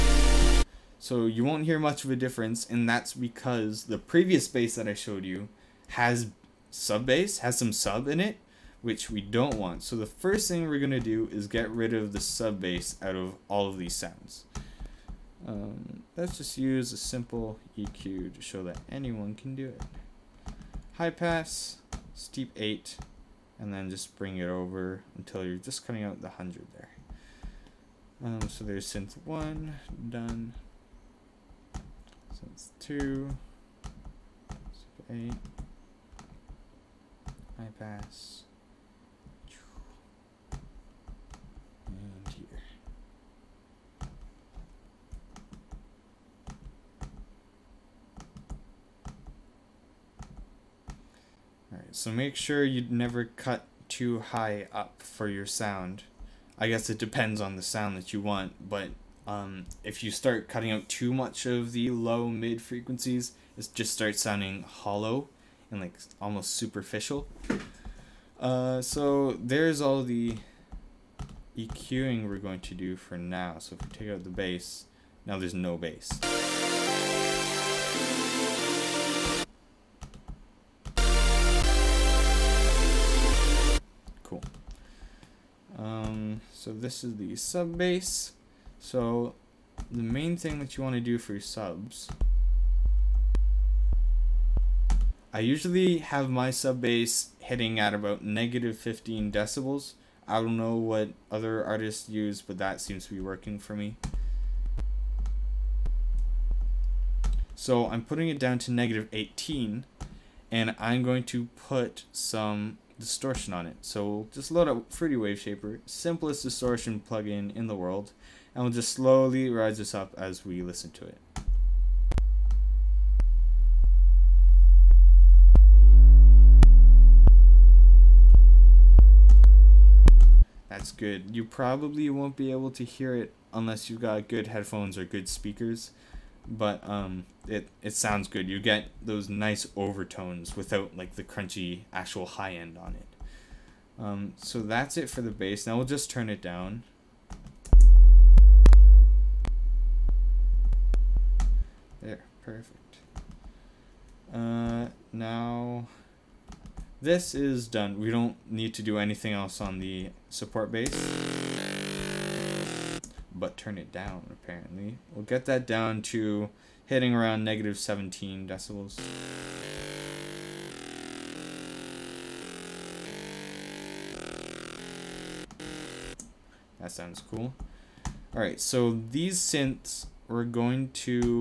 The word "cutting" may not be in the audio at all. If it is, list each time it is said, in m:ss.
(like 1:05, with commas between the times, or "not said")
0:25, 1:00.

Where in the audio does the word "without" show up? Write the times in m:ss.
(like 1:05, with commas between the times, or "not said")
2:20.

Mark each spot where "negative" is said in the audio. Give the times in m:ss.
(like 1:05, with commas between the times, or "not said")
1:38, 1:48, 2:47.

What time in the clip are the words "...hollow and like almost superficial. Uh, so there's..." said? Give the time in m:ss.
1:04.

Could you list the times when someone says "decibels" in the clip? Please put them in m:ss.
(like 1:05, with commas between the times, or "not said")
1:39, 2:48.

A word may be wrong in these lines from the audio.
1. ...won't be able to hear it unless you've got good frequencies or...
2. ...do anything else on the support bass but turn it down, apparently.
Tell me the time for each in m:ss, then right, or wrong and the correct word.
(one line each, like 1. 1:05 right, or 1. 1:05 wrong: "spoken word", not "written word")
1. 2:12 wrong: "headphones", not "frequencies"
2. 2:38 right.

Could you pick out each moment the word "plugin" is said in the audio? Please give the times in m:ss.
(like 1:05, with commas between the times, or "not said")
1:57.